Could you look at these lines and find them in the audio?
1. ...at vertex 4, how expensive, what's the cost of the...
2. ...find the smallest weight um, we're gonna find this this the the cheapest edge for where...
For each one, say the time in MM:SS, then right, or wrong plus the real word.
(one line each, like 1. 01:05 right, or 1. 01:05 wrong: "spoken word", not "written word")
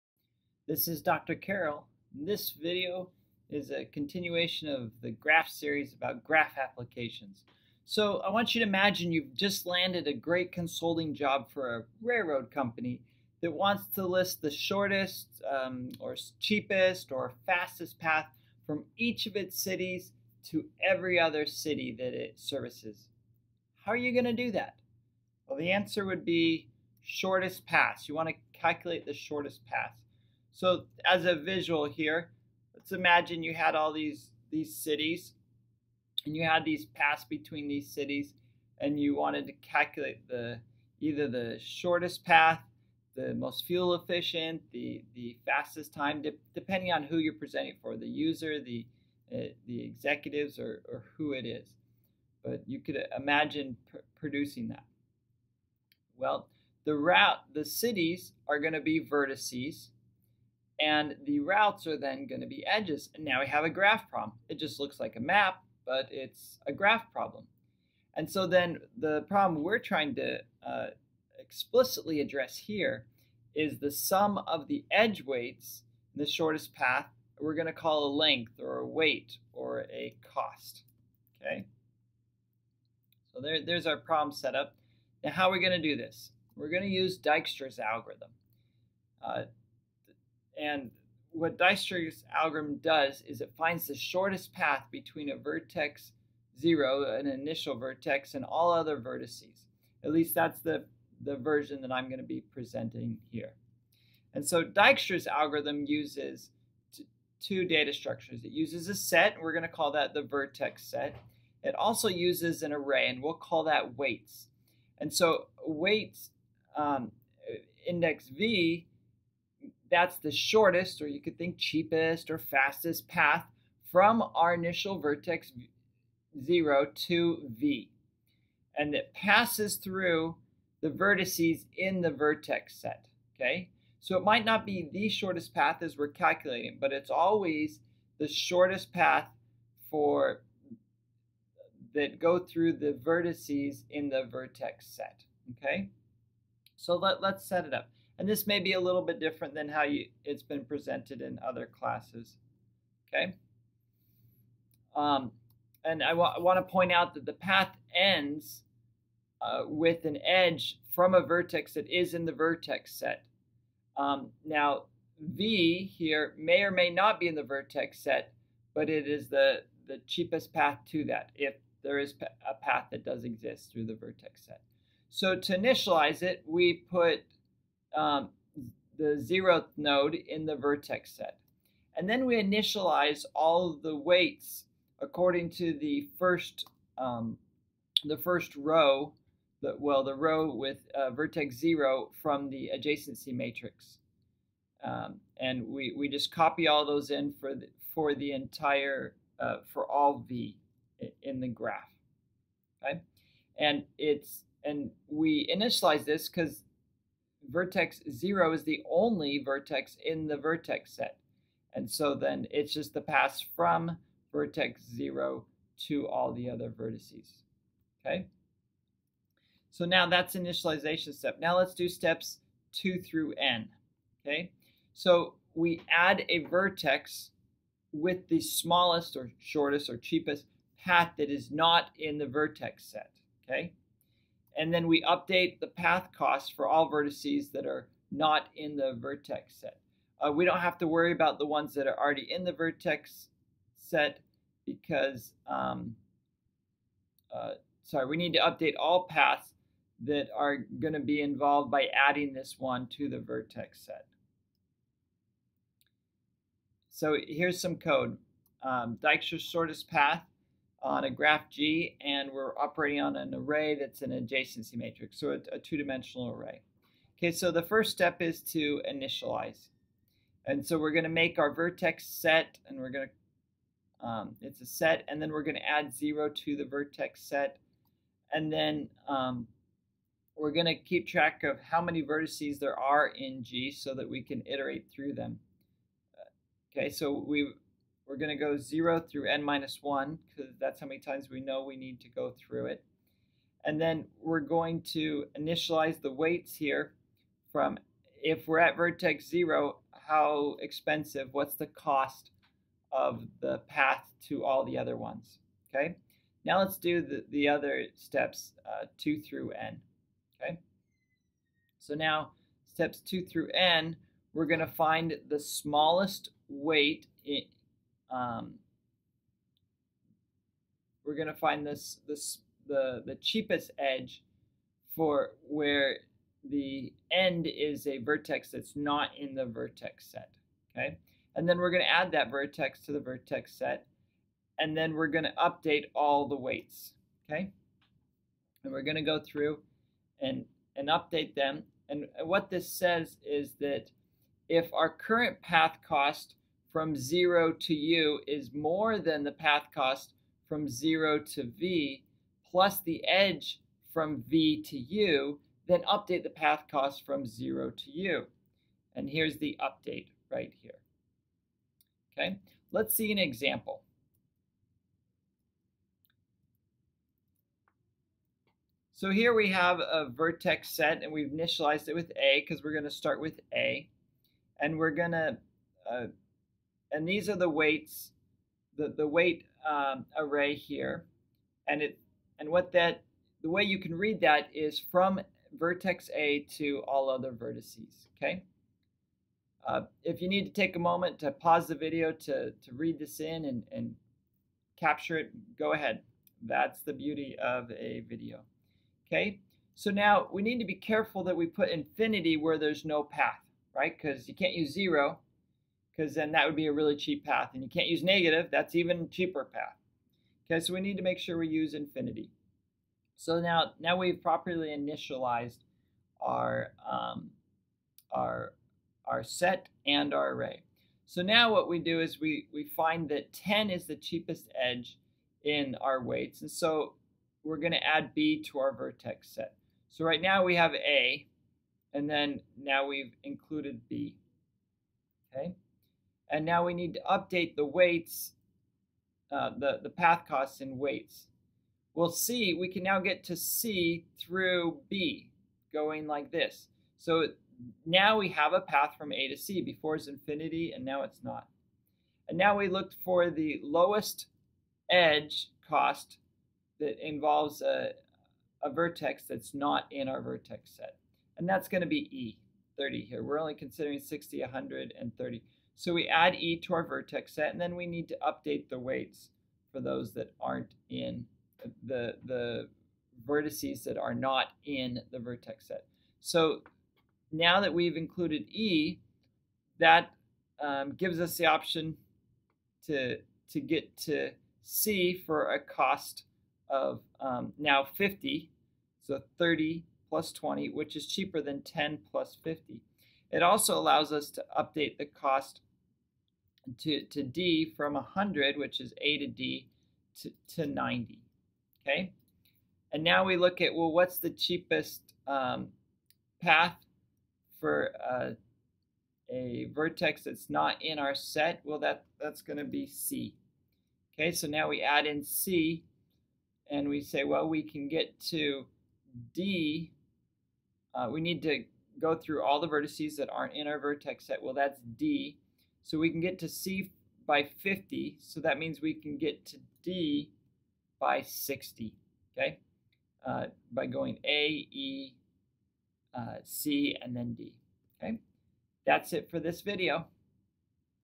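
1. 04:58 wrong: "0", not "4"
2. 05:14 right.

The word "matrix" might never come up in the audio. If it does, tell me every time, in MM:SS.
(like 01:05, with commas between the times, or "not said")
03:13, 04:24.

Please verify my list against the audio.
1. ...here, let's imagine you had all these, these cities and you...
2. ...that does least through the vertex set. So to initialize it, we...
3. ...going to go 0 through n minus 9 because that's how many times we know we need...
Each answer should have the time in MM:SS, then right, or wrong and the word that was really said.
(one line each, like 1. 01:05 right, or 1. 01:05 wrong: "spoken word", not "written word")
1. 00:31 right
2. 02:52 wrong: "exist", not "least"
3. 04:48 wrong: "1", not "9".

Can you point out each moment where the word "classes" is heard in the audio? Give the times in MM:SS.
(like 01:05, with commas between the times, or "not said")
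02:31.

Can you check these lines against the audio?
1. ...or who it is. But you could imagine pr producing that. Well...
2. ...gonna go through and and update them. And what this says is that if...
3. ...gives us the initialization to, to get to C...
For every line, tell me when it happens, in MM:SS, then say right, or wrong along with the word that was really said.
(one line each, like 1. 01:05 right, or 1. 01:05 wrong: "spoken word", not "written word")
1. 00:50 right
2. 05:38 right
3. 08:00 wrong: "option", not "initialization".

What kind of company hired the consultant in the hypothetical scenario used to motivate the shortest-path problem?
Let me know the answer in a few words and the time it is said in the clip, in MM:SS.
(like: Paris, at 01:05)
Railroad company, at 00:12.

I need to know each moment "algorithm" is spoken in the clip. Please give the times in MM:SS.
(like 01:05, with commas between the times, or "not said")
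01:27, 01:32, 01:45.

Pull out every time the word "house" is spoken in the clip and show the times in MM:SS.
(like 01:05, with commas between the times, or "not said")
not said.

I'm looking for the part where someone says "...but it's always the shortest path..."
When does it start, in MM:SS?
02:16.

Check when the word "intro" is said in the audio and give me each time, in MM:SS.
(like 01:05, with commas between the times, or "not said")
not said.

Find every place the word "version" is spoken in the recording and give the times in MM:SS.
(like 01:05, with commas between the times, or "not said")
01:41.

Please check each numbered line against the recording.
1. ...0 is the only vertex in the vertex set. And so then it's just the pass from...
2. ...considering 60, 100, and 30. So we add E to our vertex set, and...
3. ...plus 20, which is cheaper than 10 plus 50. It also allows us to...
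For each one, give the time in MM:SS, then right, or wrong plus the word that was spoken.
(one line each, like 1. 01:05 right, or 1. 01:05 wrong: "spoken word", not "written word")
1. 03:28 right
2. 07:43 right
3. 08:10 right.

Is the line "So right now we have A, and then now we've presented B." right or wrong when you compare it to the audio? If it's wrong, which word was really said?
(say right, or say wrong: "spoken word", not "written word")
wrong: "included", not "presented".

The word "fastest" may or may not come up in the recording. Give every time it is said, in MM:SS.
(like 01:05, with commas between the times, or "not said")
00:17, 00:45, 02:02.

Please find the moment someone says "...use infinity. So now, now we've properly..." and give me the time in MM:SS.
06:51.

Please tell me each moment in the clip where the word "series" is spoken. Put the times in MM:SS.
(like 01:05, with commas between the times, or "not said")
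00:05.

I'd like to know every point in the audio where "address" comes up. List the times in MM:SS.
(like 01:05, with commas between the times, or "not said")
01:12.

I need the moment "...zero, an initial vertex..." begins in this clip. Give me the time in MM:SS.
01:36.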